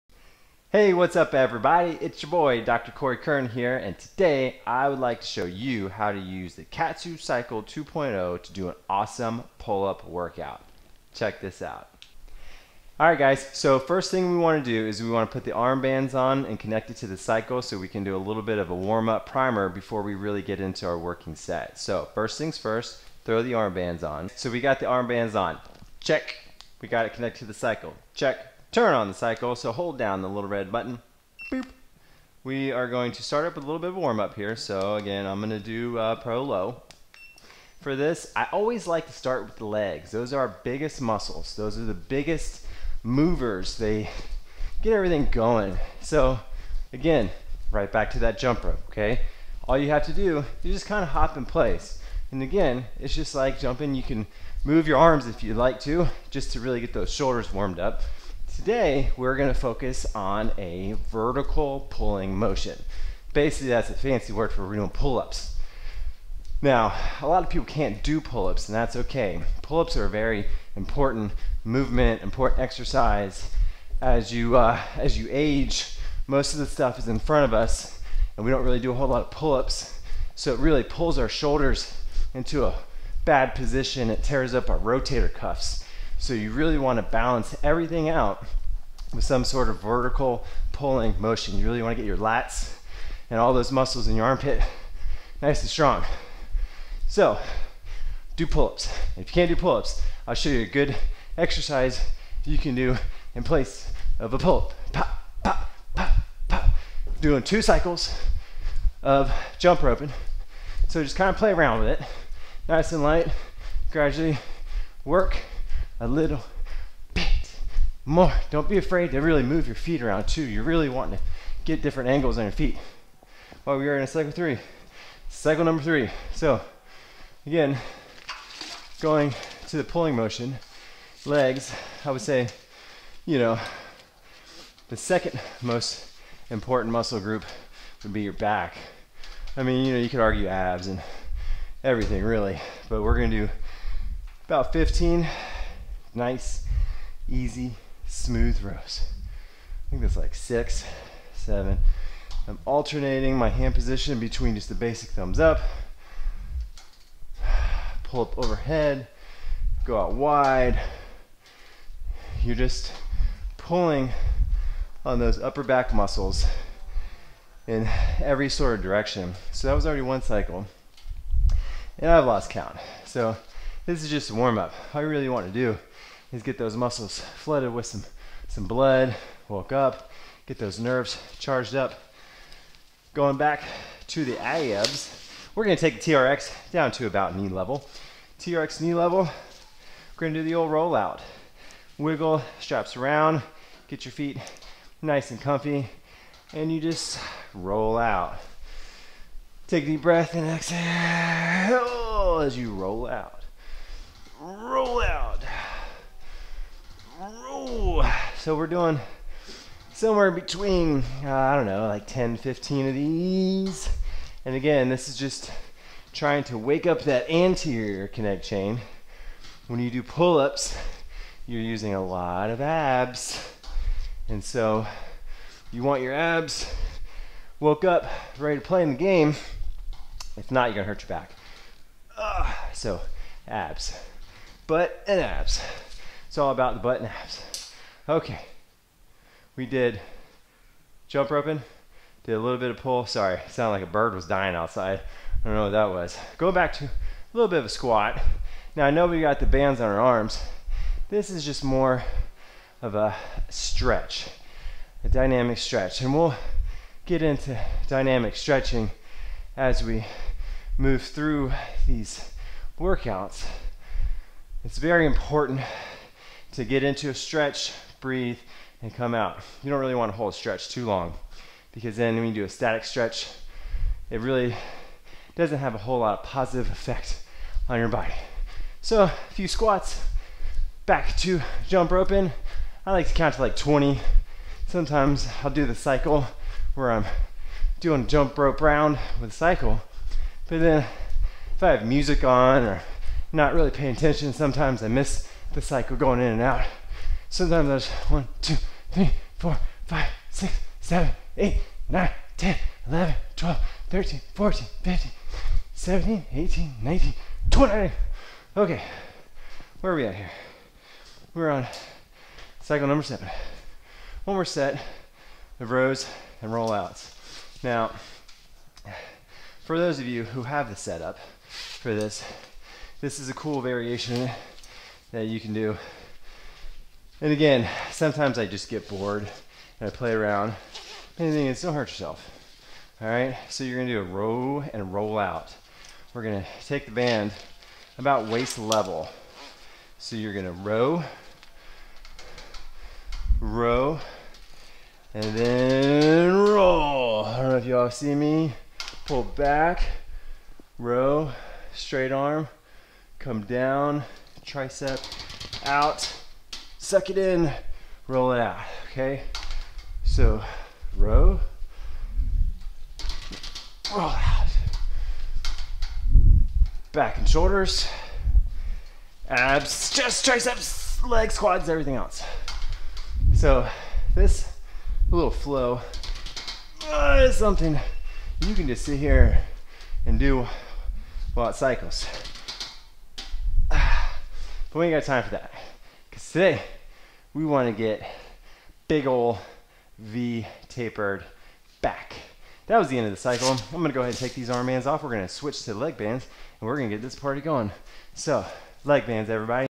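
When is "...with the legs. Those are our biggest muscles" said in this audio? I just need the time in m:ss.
0:39.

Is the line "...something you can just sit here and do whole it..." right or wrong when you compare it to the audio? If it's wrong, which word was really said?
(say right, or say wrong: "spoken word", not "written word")
wrong: "while", not "whole".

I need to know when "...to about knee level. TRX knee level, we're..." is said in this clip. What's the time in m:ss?
3:06.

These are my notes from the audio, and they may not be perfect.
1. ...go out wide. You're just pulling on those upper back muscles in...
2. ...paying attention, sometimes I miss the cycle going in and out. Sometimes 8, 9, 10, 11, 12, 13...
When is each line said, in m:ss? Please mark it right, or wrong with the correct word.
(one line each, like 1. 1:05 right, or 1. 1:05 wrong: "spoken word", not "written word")
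1. 2:39 right
2. 4:53 right.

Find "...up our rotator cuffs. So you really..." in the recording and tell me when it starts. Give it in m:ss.
1:24.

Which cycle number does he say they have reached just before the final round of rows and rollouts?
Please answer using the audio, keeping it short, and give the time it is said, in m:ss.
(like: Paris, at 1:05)
7, at 5:12.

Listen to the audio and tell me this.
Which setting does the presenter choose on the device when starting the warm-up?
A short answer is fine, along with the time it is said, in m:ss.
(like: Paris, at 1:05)
pro low, at 0:36.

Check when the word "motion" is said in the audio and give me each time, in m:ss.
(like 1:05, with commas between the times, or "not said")
1:02, 1:31, 2:10.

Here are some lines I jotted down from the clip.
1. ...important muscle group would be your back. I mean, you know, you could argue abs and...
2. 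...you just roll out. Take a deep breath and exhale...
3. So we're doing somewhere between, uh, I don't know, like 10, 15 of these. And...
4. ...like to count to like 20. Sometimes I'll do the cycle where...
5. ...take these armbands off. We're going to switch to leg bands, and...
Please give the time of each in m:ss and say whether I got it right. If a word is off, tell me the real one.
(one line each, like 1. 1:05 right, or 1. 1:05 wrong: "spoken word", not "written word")
1. 2:16 right
2. 3:16 right
3. 3:28 right
4. 4:42 right
5. 6:34 right.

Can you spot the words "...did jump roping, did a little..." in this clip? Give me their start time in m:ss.
3:59.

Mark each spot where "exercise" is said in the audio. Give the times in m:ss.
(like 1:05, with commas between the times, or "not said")
1:12, 1:41.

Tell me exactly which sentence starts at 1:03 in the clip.
Basically, that's a fancy word for doing pull-ups.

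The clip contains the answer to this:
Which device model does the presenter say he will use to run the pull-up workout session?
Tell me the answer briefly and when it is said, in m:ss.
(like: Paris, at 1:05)
KAATSU Cycle 2.0, at 0:06.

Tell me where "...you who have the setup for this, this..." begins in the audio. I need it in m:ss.
5:20.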